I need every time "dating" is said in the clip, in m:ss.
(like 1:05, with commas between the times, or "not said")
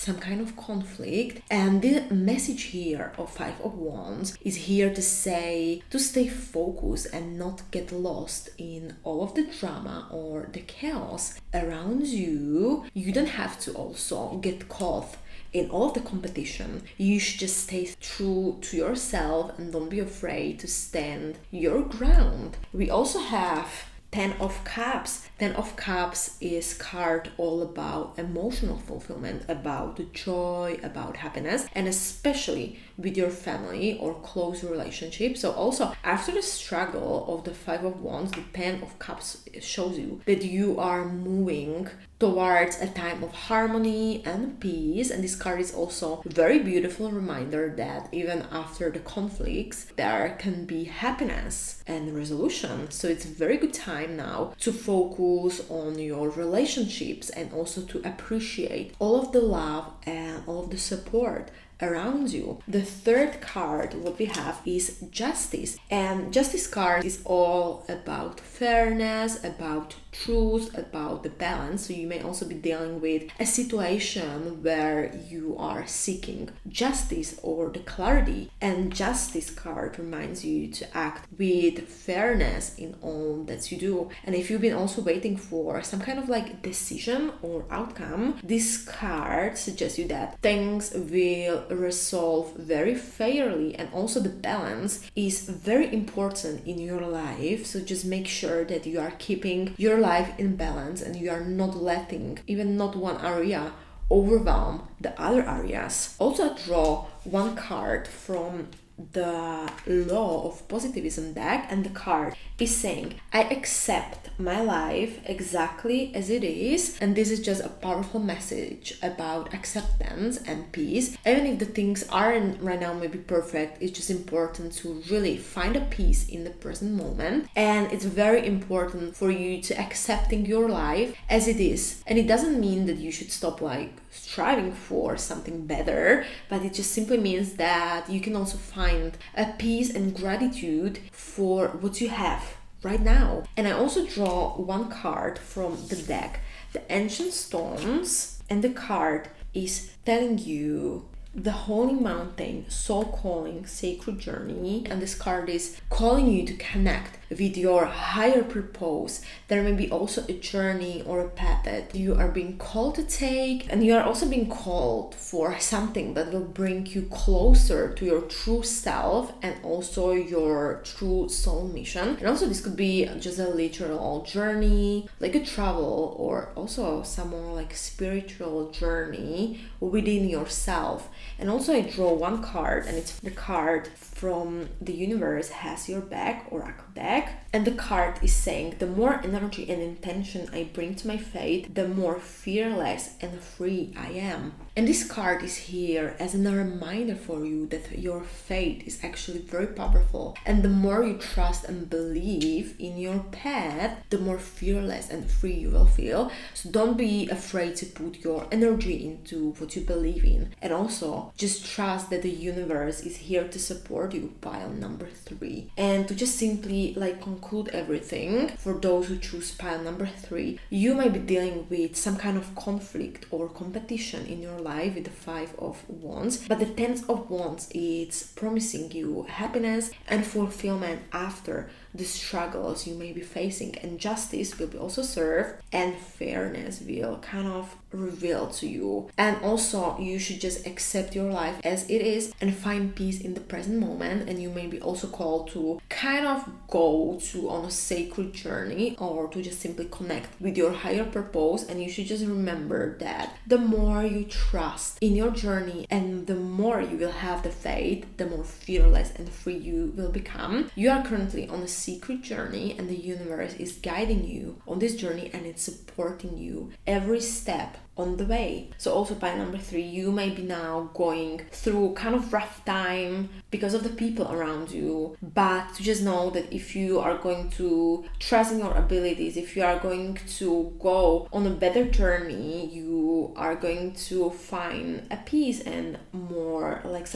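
not said.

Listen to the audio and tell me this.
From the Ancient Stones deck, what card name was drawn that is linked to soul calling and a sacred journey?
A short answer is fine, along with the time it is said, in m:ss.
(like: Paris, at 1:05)
The Holy Mountain, at 2:31.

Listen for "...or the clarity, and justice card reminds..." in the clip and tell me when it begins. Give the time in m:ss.
1:17.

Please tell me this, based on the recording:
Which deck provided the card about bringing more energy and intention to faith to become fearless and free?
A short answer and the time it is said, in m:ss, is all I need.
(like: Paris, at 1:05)
The Universe Has Your Back, at 3:04.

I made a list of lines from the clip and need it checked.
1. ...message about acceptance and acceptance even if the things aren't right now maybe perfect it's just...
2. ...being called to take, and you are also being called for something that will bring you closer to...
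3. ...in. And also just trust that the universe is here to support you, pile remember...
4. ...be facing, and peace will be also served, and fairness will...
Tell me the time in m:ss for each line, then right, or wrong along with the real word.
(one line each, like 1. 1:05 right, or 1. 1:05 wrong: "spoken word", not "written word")
1. 1:58 wrong: "peace", not "acceptance"
2. 2:42 right
3. 3:30 wrong: "number", not "remember"
4. 3:53 wrong: "justice", not "peace".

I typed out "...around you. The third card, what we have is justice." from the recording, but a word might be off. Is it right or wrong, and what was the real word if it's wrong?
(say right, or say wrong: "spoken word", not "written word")
right.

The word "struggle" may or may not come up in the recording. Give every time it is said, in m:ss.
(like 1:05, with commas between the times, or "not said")
0:36, 3:52.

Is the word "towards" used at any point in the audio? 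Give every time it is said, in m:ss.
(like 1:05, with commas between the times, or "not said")
0:42.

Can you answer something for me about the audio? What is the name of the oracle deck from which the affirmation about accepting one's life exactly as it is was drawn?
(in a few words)
Law of Positivism.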